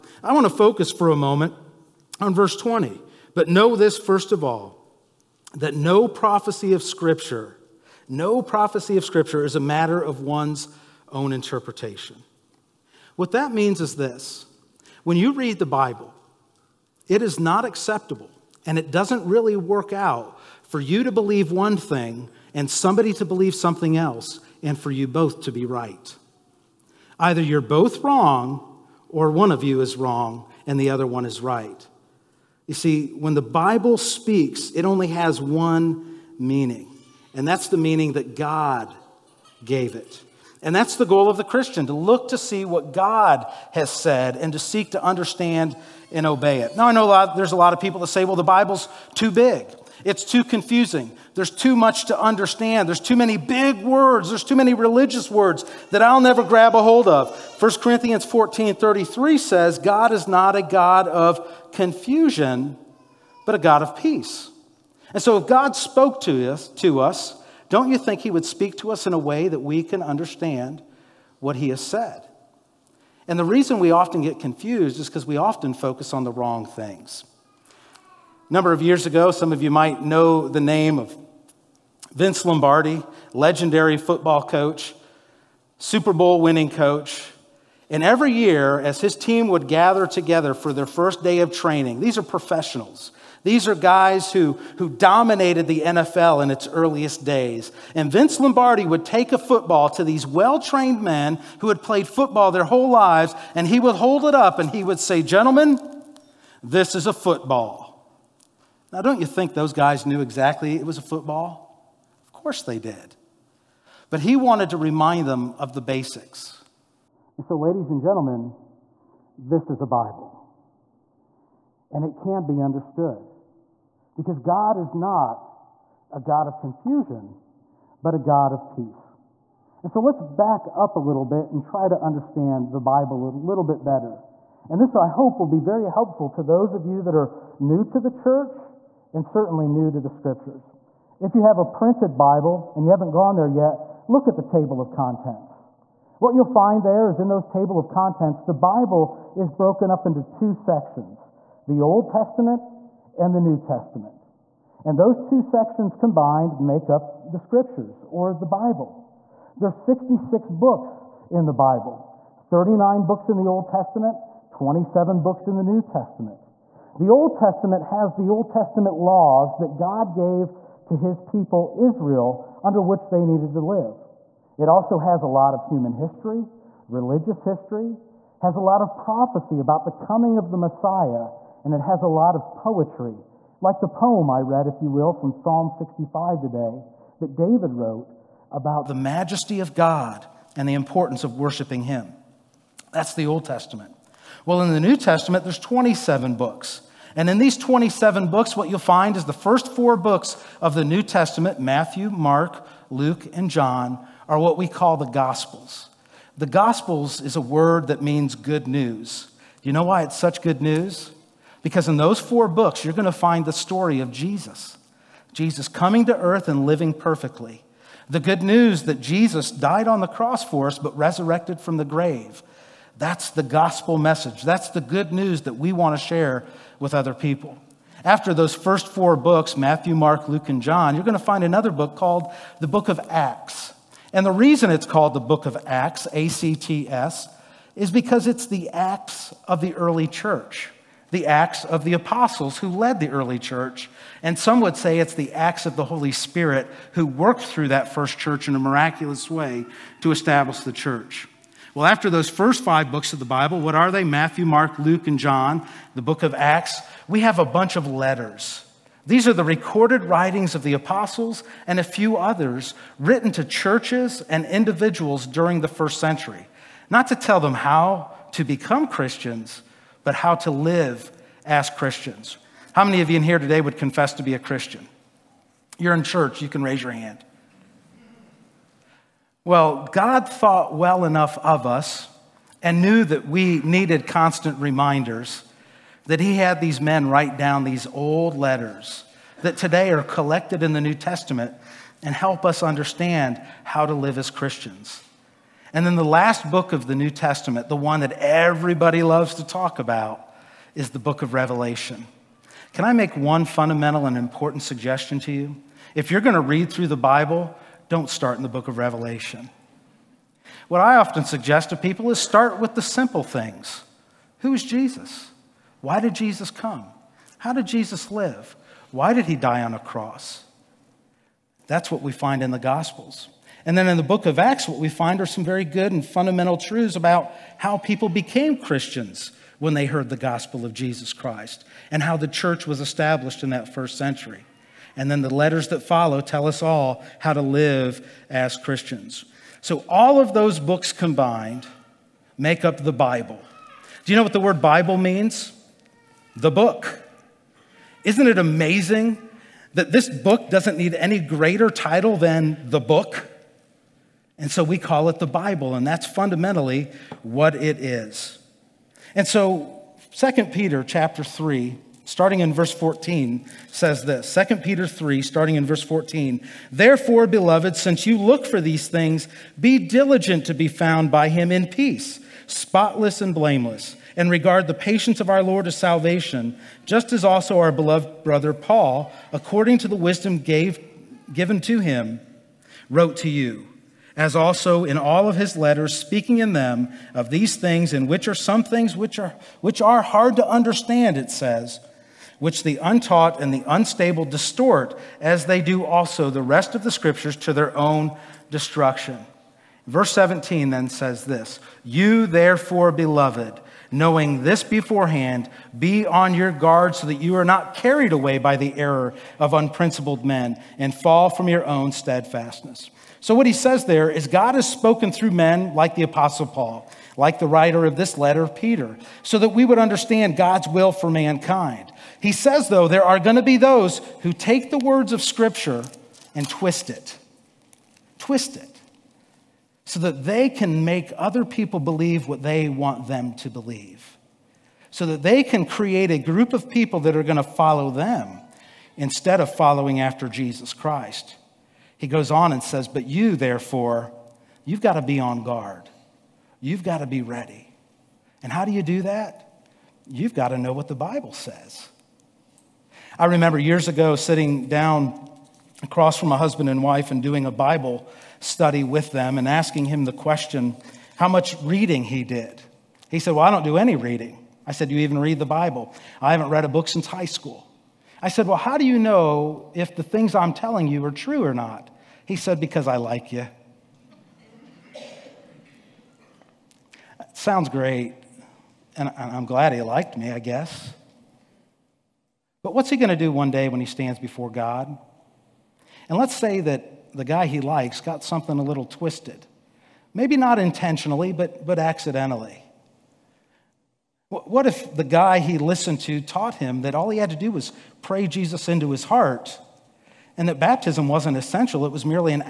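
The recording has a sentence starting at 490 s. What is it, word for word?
Maybe not intentionally, but, but accidentally.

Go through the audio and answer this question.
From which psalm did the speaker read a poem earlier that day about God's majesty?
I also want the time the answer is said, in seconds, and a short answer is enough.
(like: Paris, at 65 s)
Psalm 65, at 185 s.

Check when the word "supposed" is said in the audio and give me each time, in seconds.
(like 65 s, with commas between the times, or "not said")
not said.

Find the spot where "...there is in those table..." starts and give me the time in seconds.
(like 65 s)
146 s.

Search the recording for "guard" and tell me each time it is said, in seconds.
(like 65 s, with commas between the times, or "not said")
406 s, 445 s.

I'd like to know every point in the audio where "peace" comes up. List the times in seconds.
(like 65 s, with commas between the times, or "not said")
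63 s, 128 s, 371 s.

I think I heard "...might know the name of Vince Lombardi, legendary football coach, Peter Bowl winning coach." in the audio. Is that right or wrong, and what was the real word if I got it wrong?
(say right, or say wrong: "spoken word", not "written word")
wrong: "Super", not "Peter".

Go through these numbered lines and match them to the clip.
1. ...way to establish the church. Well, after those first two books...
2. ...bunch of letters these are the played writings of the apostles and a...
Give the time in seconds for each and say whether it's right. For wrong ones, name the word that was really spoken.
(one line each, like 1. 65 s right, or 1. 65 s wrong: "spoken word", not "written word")
1. 249 s wrong: "five", not "two"
2. 257 s wrong: "recorded", not "played".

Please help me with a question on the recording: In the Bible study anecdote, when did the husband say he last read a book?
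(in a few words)
since high school.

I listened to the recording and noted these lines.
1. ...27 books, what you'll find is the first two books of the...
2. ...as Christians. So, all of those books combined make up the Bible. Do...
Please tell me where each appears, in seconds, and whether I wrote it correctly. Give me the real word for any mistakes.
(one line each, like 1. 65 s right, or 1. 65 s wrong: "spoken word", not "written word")
1. 197 s wrong: "four", not "two"
2. 338 s right.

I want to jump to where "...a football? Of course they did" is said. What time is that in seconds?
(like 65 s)
110 s.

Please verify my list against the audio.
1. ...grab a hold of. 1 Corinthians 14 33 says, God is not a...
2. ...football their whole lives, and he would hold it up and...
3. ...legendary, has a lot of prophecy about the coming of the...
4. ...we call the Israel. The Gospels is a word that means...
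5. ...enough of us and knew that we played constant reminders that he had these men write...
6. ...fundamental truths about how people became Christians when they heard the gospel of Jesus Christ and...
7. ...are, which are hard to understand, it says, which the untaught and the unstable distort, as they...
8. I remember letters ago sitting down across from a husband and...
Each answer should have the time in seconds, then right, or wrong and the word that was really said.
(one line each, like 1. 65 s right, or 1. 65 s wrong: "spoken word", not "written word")
1. 56 s right
2. 102 s right
3. 177 s wrong: "history", not "legendary"
4. 204 s wrong: "Gospels", not "Israel"
5. 281 s wrong: "needed", not "played"
6. 326 s right
7. 389 s right
8. 453 s wrong: "years", not "letters".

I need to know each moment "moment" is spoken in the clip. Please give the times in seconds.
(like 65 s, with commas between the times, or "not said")
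1 s.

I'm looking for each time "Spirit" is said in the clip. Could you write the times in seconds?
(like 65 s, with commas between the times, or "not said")
246 s.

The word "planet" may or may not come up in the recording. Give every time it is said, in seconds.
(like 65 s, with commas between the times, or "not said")
not said.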